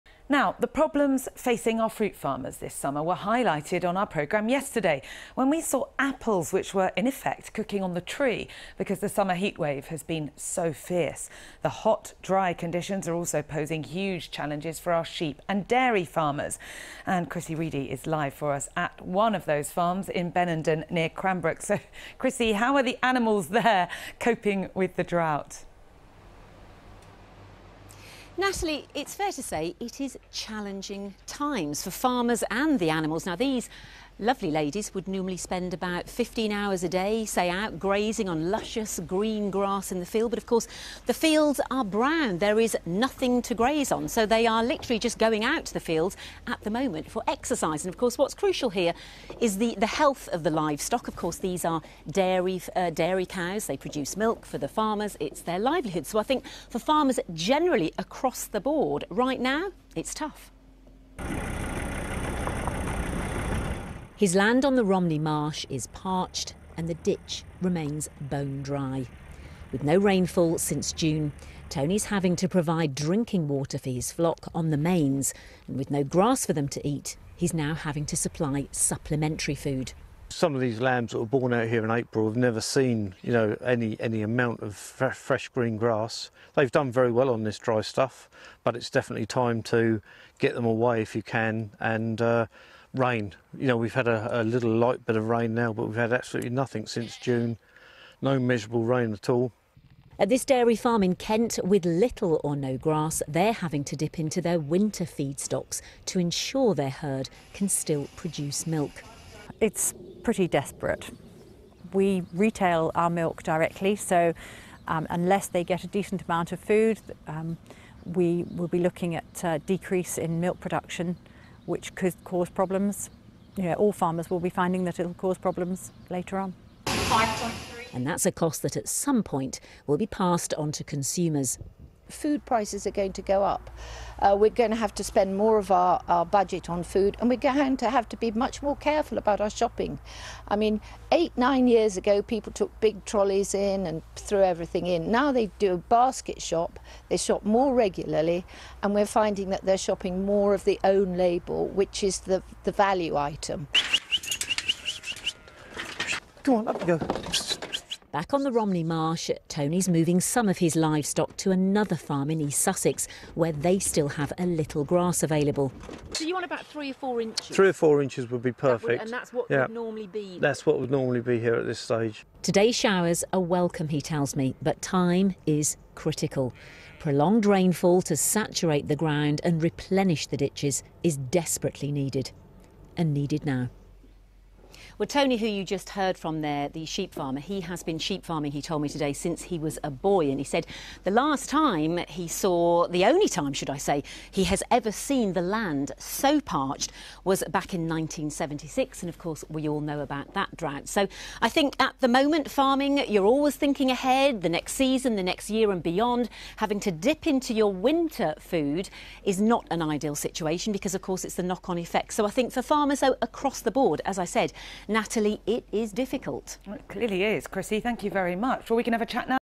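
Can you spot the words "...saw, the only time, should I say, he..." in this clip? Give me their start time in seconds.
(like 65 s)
192 s.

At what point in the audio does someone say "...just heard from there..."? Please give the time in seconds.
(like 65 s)
185 s.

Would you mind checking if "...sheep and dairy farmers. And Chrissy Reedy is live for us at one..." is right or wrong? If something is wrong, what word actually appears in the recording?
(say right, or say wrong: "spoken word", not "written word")
right.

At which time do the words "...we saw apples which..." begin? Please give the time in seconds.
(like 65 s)
5 s.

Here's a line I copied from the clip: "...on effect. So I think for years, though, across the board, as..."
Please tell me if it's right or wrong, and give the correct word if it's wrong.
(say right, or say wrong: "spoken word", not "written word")
wrong: "farmers", not "years".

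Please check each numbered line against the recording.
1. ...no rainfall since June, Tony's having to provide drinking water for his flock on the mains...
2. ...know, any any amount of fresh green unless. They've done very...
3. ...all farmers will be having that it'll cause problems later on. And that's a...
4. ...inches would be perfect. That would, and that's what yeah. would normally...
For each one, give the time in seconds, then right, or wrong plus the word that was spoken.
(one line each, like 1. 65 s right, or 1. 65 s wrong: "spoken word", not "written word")
1. 69 s right
2. 83 s wrong: "grass", not "unless"
3. 123 s wrong: "finding", not "having"
4. 168 s right.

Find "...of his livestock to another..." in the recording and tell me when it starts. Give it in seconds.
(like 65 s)
160 s.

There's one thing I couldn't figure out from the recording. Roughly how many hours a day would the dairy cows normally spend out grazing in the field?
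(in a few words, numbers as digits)
15.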